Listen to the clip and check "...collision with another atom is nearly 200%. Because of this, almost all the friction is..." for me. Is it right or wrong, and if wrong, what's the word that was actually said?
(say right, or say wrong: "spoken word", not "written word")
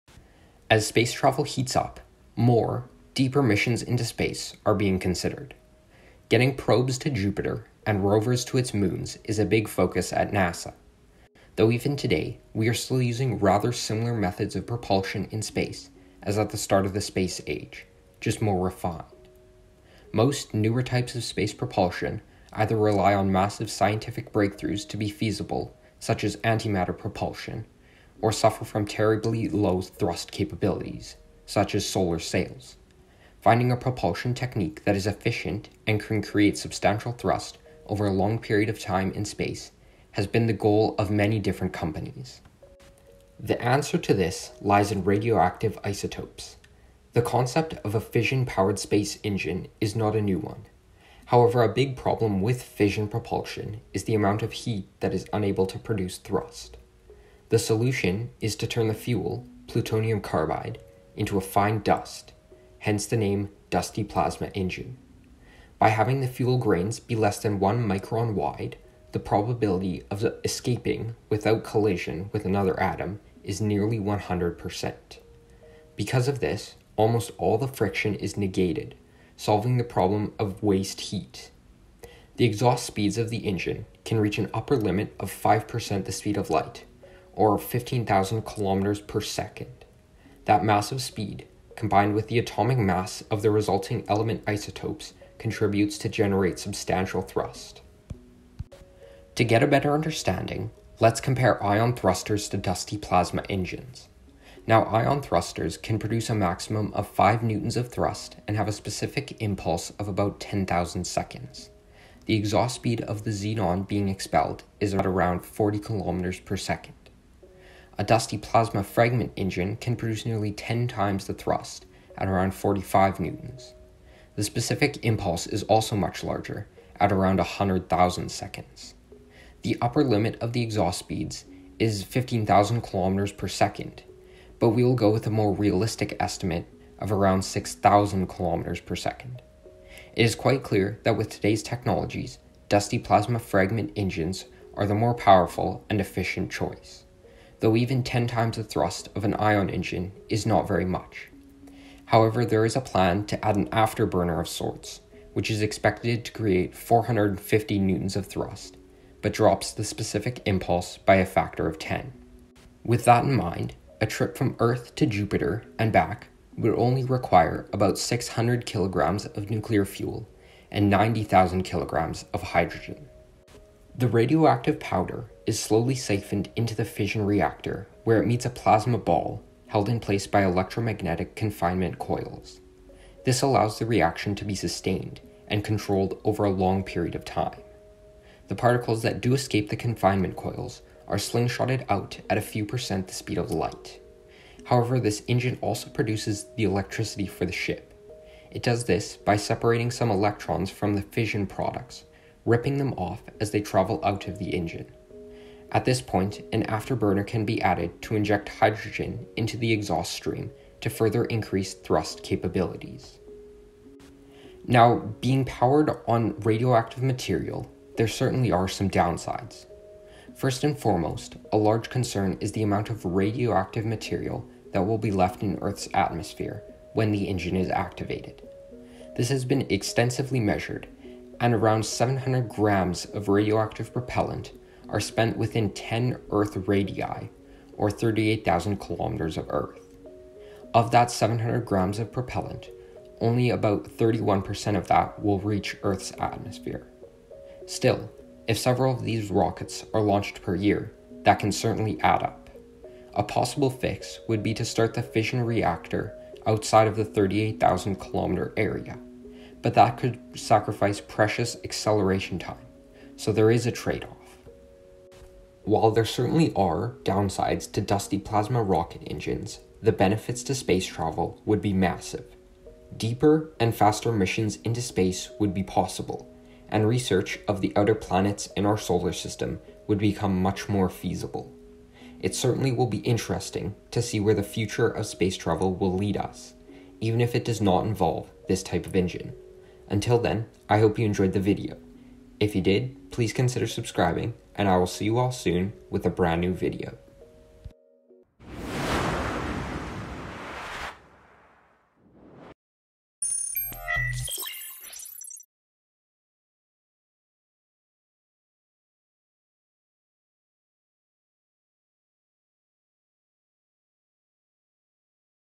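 wrong: "100", not "200".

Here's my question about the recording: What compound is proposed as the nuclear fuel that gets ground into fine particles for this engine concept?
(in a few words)
plutonium carbide.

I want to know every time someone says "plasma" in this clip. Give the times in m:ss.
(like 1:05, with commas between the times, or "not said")
1:04, 1:42, 1:58, 2:22, 2:58, 4:28.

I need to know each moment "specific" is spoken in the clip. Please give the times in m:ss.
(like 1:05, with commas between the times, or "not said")
1:48, 2:04, 2:39.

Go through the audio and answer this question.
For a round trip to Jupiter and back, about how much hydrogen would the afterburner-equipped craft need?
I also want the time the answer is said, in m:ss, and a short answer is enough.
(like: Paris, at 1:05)
90,000 kilograms, at 2:50.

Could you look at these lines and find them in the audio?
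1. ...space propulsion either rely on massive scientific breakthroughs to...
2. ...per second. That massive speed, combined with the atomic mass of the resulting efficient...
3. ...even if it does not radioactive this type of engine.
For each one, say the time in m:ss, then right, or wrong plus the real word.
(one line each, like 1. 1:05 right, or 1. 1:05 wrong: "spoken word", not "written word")
1. 0:21 right
2. 1:29 wrong: "element", not "efficient"
3. 4:46 wrong: "involve", not "radioactive".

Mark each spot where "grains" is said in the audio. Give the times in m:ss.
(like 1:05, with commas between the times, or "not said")
1:06.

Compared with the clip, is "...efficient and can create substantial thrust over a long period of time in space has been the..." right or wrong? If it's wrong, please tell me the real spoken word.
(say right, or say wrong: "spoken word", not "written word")
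right.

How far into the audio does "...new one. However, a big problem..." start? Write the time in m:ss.
0:50.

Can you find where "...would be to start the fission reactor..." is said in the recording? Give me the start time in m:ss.
4:14.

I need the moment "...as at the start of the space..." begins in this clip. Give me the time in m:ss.
0:16.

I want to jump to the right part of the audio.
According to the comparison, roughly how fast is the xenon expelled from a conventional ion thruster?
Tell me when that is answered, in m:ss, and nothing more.
1:55.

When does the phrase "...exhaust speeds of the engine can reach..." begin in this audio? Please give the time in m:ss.
1:22.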